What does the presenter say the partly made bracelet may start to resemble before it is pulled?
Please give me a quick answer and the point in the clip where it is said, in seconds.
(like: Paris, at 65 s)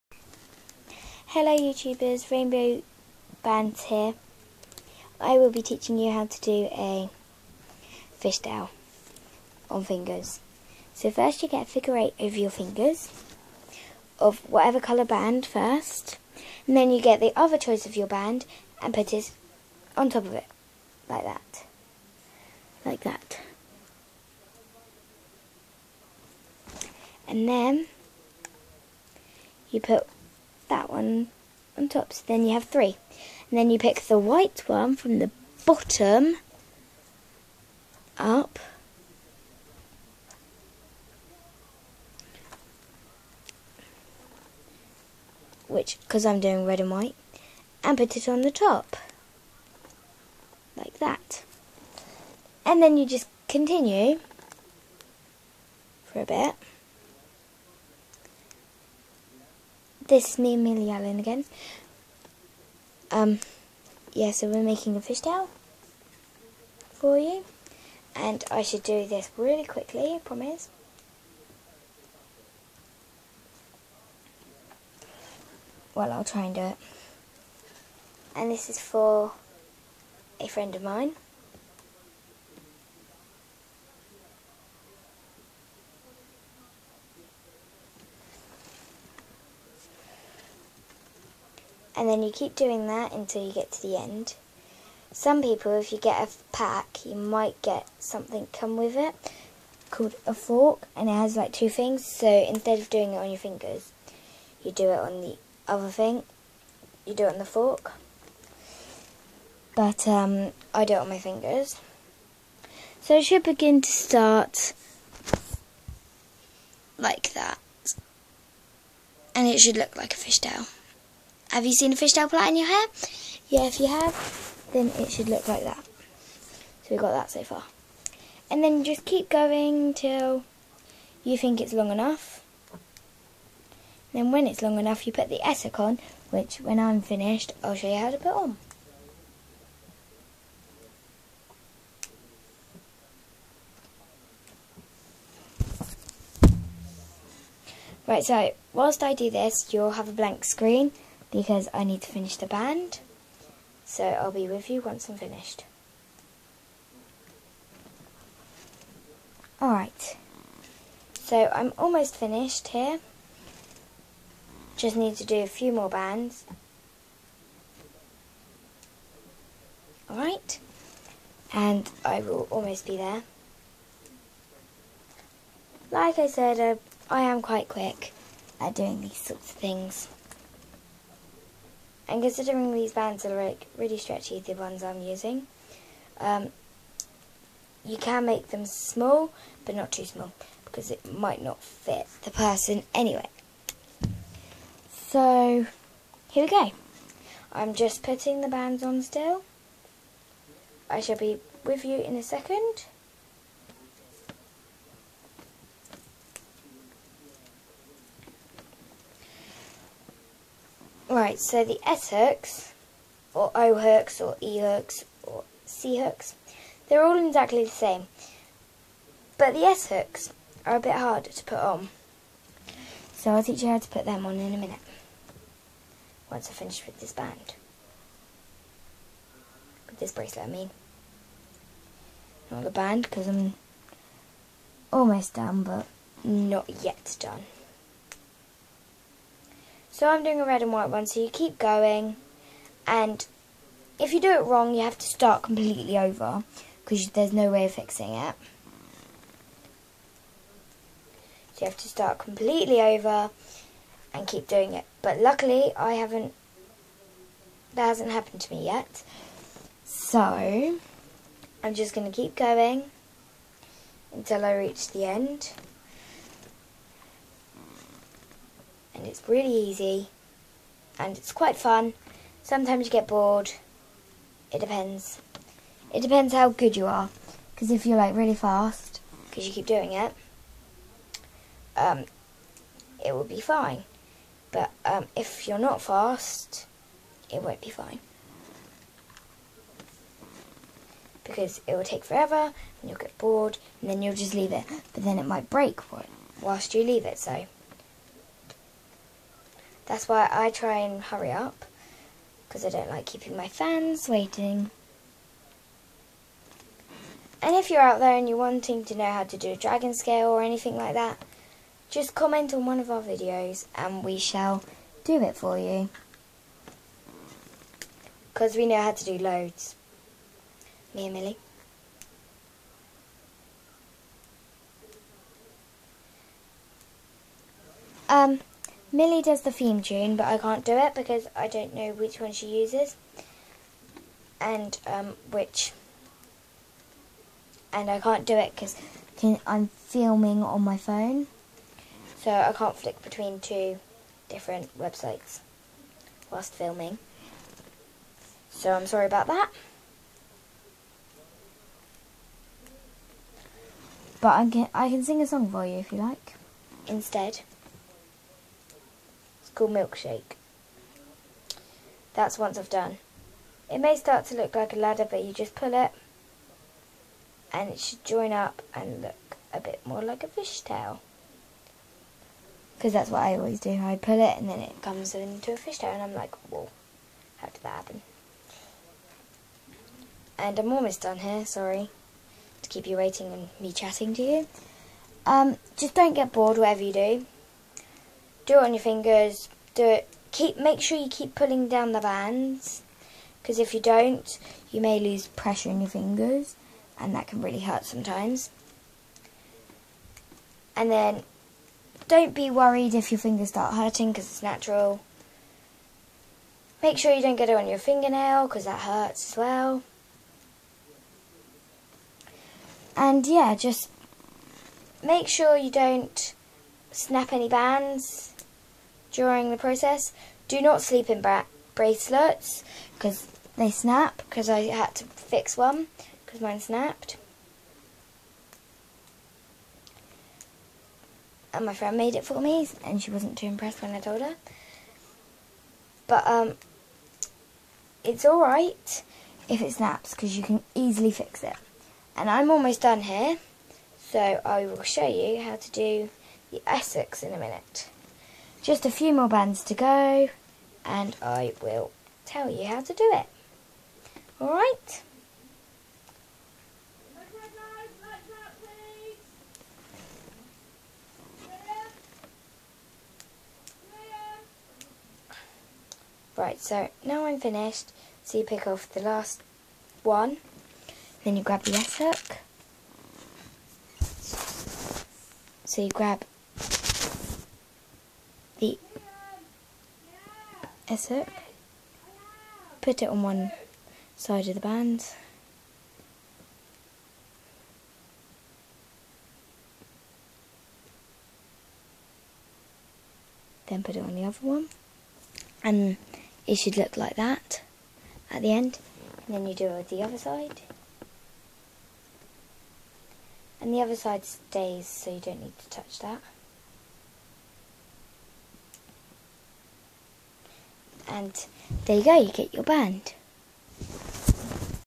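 A ladder, at 364 s.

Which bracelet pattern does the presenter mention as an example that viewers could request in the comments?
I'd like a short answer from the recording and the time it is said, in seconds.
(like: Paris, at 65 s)
Dragon scale, at 309 s.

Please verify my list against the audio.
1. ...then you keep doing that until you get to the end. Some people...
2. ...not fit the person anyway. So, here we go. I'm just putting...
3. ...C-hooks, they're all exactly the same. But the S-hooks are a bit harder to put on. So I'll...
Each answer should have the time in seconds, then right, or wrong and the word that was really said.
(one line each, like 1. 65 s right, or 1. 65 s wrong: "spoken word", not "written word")
1. 92 s right
2. 191 s right
3. 215 s right.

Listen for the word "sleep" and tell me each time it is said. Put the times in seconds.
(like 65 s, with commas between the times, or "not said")
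420 s.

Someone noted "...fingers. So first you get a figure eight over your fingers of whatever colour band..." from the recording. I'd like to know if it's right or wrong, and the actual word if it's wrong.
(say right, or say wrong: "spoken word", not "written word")
right.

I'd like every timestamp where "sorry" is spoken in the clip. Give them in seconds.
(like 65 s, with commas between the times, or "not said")
348 s, 381 s.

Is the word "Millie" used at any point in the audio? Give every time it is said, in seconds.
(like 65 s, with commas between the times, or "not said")
60 s, 321 s, 328 s.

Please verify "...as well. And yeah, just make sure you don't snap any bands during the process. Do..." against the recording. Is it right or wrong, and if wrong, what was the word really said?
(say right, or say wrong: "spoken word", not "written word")
right.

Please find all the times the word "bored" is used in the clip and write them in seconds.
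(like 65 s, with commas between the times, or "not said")
273 s, 293 s, 386 s.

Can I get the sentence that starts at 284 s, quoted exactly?
But um, if you're not fast, it won't be fine.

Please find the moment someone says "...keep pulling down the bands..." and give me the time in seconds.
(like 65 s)
391 s.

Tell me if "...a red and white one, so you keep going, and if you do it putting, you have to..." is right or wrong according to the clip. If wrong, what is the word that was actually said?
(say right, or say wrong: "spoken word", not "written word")
wrong: "wrong", not "putting".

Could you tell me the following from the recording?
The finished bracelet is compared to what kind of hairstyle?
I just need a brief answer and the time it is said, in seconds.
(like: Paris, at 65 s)
Fishtail plait, at 121 s.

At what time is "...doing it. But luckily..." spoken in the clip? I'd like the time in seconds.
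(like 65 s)
254 s.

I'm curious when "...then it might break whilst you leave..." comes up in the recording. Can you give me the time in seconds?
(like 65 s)
295 s.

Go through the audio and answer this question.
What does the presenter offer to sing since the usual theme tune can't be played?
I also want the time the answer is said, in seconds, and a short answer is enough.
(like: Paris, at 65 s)
Milkshake, at 359 s.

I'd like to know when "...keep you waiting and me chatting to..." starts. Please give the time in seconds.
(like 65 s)
382 s.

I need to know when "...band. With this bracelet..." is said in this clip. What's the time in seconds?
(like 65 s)
227 s.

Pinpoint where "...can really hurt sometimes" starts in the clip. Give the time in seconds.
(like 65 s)
397 s.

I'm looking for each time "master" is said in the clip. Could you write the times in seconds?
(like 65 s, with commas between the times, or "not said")
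not said.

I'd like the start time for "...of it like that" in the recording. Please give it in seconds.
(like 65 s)
20 s.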